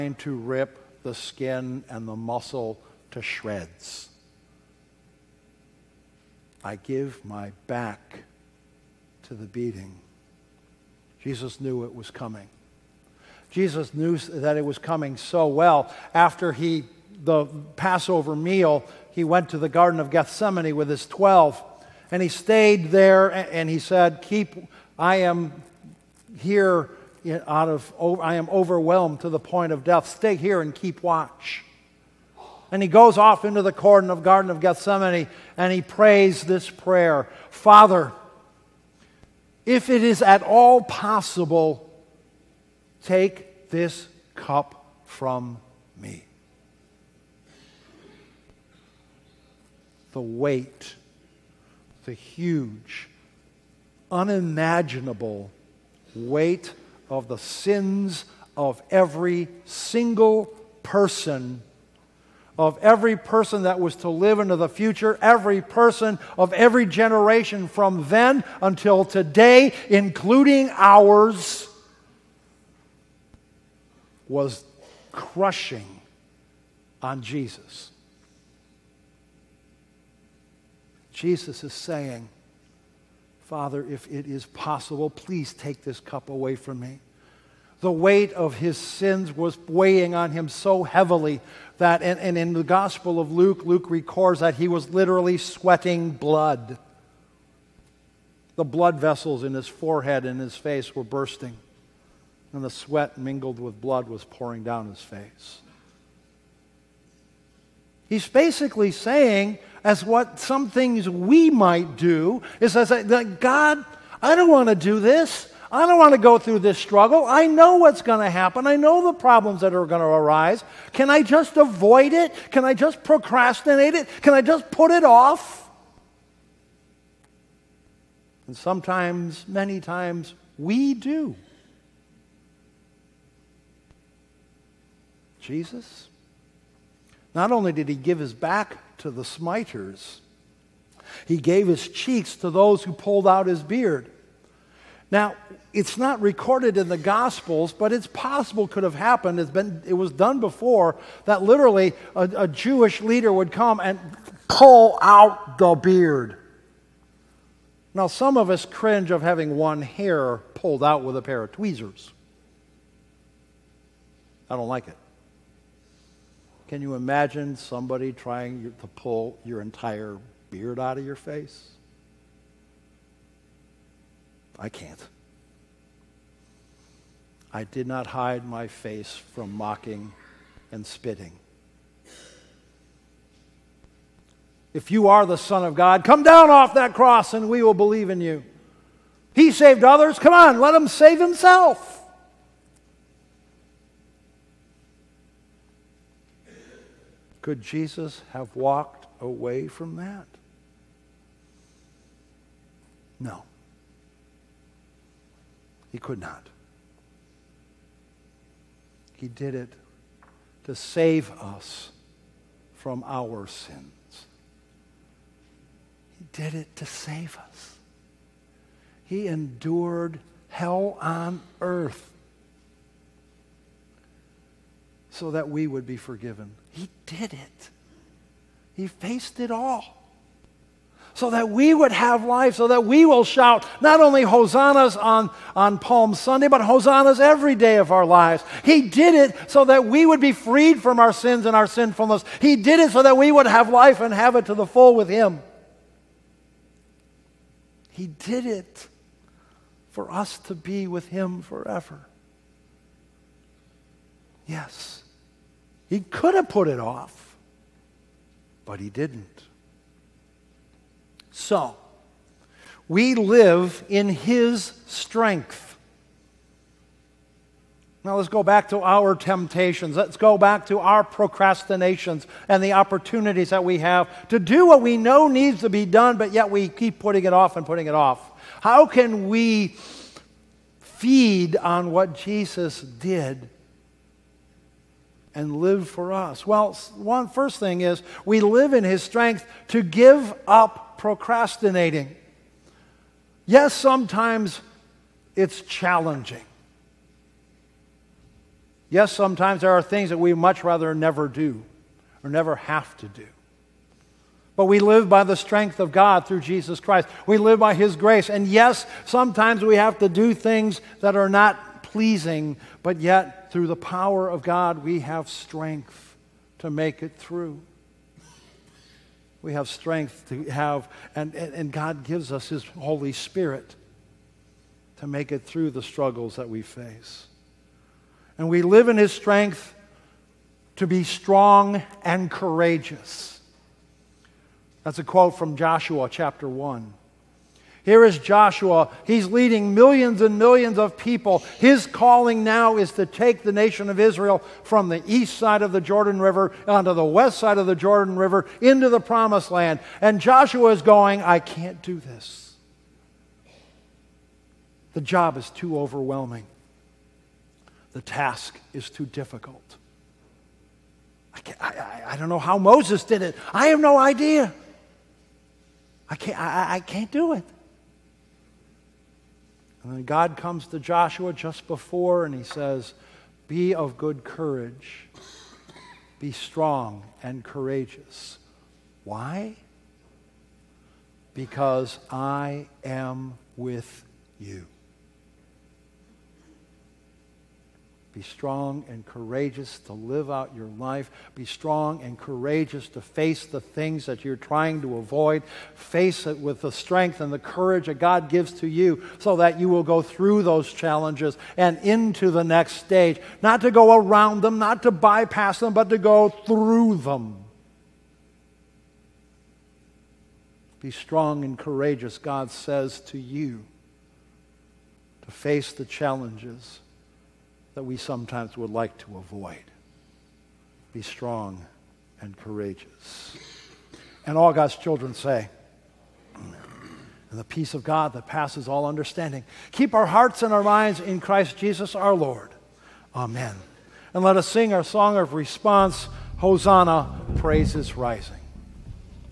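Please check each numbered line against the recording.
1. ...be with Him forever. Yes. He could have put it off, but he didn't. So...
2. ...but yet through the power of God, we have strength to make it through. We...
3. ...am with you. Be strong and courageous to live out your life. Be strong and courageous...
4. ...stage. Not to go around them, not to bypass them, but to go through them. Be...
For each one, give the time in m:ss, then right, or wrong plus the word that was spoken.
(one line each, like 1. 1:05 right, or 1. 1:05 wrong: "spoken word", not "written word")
1. 4:10 right
2. 5:12 right
3. 6:22 right
4. 6:42 right.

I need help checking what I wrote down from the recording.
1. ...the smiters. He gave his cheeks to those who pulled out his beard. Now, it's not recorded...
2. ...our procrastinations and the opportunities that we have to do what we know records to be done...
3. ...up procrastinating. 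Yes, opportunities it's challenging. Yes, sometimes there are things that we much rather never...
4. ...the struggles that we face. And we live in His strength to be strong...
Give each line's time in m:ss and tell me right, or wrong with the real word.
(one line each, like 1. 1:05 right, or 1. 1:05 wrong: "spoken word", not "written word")
1. 2:19 right
2. 4:30 wrong: "needs", not "records"
3. 4:50 wrong: "sometimes", not "opportunities"
4. 5:25 right.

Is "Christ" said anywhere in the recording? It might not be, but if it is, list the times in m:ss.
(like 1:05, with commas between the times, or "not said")
5:06, 7:11.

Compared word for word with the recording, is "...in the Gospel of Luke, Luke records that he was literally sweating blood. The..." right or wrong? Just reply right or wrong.
right.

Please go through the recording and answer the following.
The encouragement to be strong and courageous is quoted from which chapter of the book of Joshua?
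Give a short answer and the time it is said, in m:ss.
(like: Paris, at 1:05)
Chapter 1, at 5:35.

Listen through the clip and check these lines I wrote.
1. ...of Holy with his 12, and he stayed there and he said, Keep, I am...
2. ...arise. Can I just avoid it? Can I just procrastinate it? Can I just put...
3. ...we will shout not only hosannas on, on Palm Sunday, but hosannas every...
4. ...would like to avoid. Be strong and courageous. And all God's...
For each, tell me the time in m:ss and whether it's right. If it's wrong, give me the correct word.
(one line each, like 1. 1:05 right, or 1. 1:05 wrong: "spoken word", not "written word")
1. 0:19 wrong: "Gethsemane", not "Holy"
2. 2:00 right
3. 3:52 right
4. 6:58 right.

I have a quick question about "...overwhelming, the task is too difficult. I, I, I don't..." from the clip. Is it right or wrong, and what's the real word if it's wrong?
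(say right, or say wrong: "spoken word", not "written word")
right.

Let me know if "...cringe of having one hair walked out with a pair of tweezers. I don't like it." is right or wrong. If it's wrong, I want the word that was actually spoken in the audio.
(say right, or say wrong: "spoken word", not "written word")
wrong: "pulled", not "walked".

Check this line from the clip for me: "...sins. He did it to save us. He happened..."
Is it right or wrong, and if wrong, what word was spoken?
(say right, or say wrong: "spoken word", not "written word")
wrong: "endured", not "happened".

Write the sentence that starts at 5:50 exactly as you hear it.
And Joshua is going, I can't do this.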